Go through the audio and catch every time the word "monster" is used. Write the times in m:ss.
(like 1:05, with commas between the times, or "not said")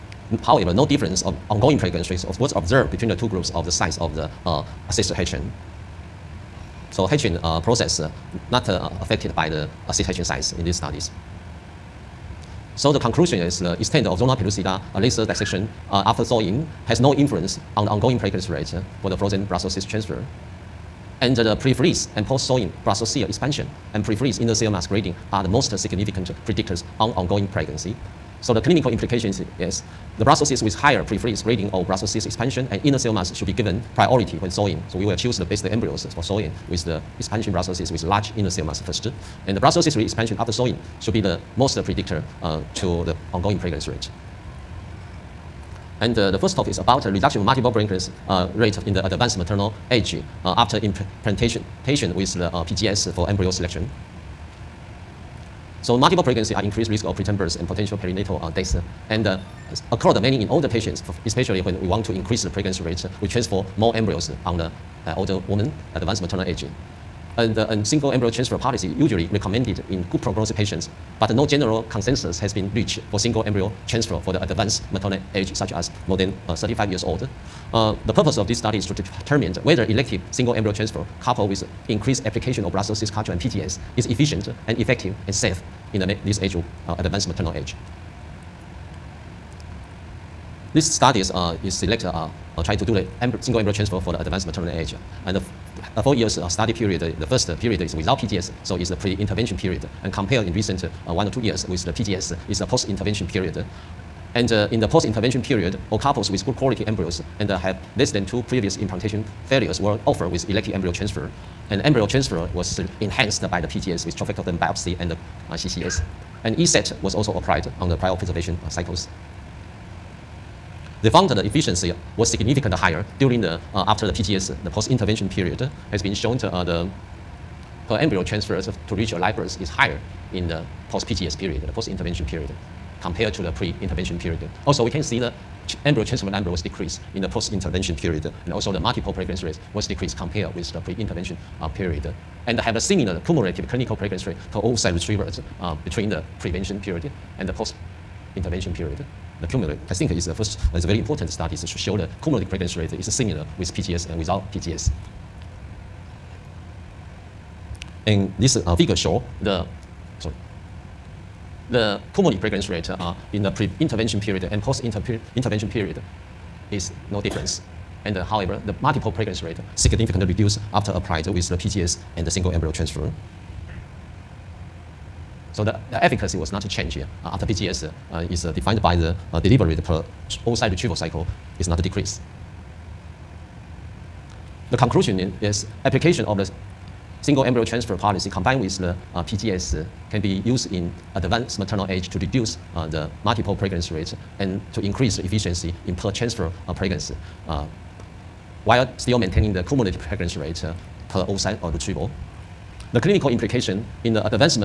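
not said.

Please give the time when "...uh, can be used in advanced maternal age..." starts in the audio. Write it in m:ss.
3:09.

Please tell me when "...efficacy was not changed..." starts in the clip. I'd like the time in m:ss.
2:56.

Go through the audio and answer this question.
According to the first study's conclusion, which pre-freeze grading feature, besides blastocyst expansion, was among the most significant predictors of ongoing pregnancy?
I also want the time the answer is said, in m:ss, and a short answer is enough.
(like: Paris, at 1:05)
Inner cell mass grading, at 0:24.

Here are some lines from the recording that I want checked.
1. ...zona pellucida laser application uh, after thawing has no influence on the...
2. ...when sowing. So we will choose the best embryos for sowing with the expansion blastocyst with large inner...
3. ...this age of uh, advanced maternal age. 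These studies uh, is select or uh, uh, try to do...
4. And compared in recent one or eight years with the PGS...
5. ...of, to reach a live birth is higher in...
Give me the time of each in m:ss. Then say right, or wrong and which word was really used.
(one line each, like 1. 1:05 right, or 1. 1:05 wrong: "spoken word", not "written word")
1. 0:14 wrong: "dissection", not "application"
2. 0:34 right
3. 1:26 right
4. 1:40 wrong: "two", not "eight"
5. 2:08 right.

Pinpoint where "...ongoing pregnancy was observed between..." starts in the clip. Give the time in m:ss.
0:01.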